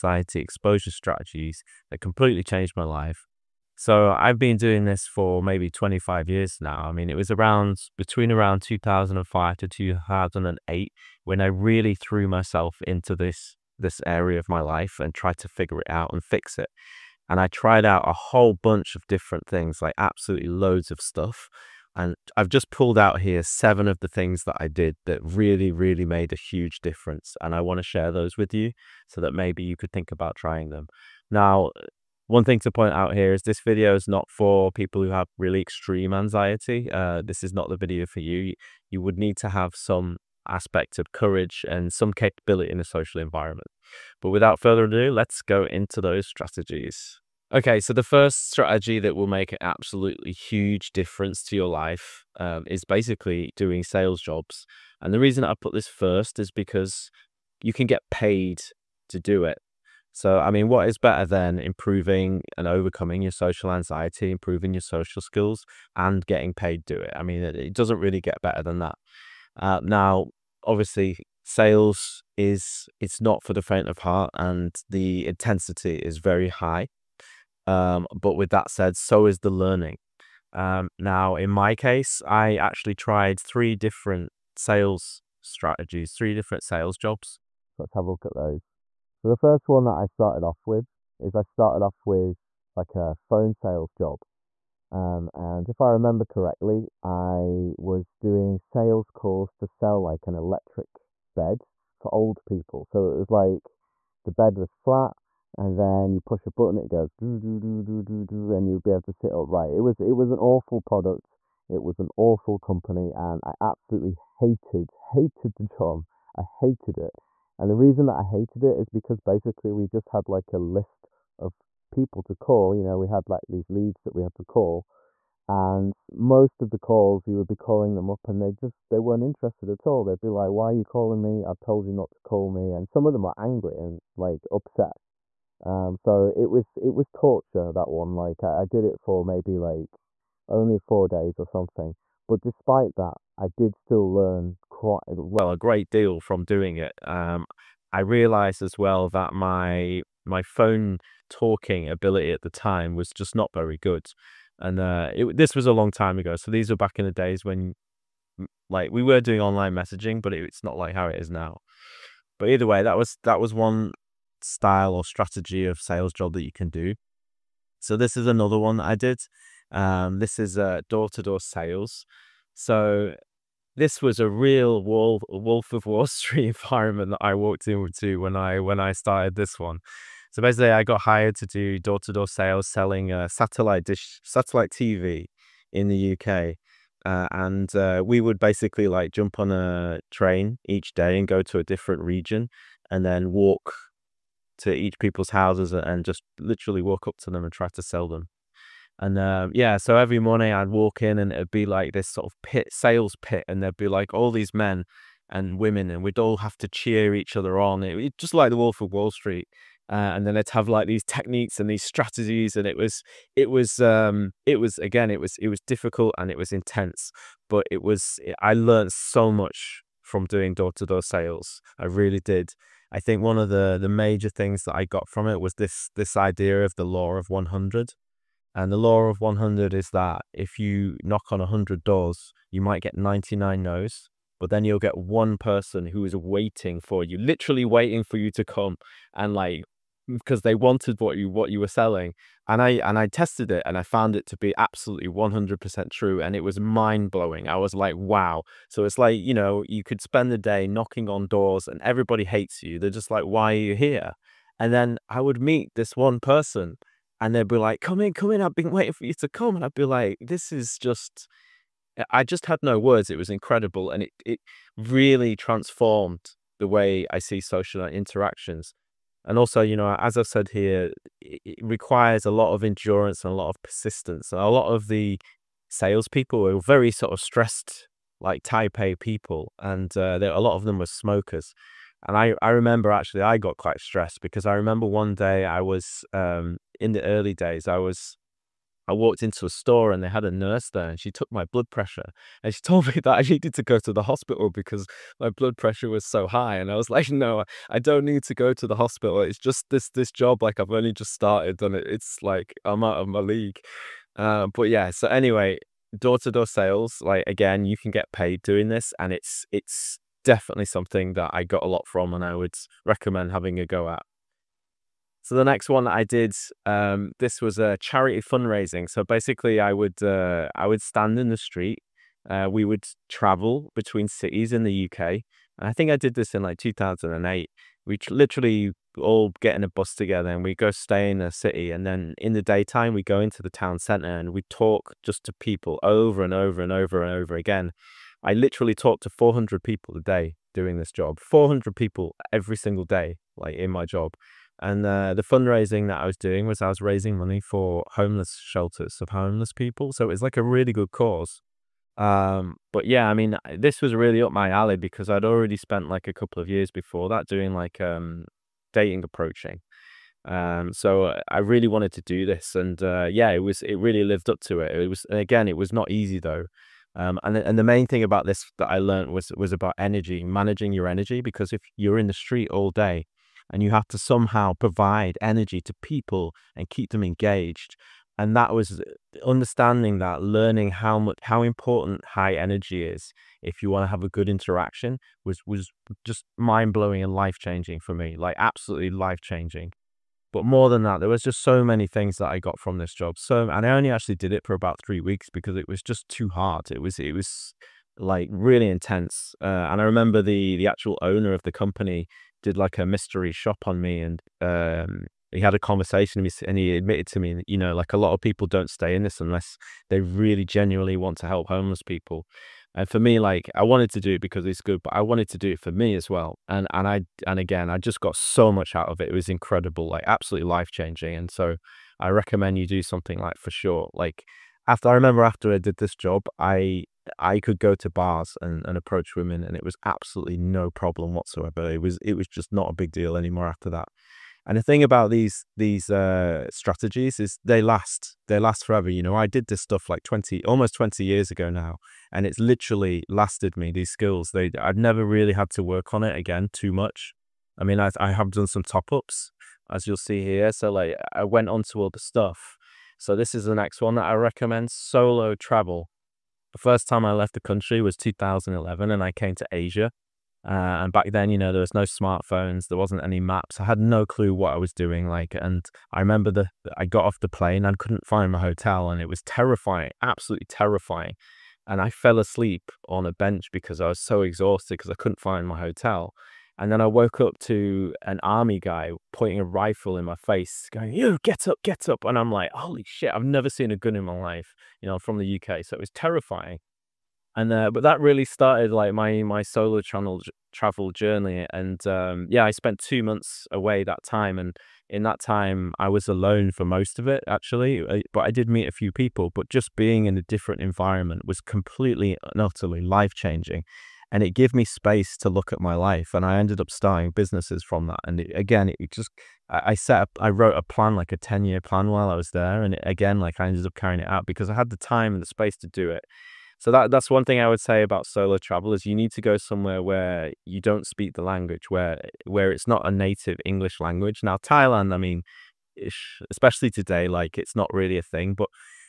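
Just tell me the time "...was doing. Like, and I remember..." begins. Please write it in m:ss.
7:44.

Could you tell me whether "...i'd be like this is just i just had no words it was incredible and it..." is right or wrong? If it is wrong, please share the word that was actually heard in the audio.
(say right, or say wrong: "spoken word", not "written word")
right.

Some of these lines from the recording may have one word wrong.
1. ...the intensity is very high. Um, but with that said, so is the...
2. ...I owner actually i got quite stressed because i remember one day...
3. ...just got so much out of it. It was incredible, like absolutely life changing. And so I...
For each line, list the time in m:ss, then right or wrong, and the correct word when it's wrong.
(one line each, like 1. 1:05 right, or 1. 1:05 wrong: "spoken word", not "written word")
1. 1:14 right
2. 4:42 wrong: "remember", not "owner"
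3. 6:57 right.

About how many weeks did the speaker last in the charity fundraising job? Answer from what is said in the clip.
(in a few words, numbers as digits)
3.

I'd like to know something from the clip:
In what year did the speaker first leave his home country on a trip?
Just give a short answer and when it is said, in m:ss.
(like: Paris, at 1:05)
2011, at 7:37.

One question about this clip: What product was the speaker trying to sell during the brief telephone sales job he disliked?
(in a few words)
an electric bed.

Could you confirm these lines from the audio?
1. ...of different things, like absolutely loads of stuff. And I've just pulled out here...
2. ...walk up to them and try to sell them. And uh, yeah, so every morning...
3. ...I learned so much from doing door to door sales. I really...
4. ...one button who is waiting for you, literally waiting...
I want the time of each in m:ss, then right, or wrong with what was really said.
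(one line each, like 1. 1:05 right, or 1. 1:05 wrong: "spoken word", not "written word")
1. 0:18 right
2. 3:16 right
3. 3:38 right
4. 3:54 wrong: "person", not "button".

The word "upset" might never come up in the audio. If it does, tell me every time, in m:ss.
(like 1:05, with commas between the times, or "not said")
2:14.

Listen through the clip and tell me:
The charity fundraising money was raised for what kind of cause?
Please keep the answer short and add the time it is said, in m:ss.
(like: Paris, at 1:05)
homeless shelters, at 5:47.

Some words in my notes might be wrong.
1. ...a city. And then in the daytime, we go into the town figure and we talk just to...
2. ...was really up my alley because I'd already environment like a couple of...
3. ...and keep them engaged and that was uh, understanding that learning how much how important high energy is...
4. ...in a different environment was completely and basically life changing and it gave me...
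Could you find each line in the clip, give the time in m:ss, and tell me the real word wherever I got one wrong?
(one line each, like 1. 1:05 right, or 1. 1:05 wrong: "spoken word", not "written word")
1. 5:31 wrong: "centre", not "figure"
2. 5:53 wrong: "spent", not "environment"
3. 6:16 right
4. 8:20 wrong: "utterly", not "basically".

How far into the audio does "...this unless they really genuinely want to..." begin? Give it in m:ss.
6:49.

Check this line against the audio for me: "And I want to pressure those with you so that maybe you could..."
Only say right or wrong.
wrong.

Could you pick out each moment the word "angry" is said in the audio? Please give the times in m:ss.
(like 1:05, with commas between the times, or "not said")
2:13.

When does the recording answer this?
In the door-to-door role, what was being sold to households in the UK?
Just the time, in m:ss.
3:04.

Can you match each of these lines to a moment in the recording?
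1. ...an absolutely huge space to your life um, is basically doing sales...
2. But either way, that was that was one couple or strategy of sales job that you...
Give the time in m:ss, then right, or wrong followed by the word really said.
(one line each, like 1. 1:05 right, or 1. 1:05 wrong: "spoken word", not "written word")
1. 0:49 wrong: "difference", not "space"
2. 2:42 wrong: "style", not "couple".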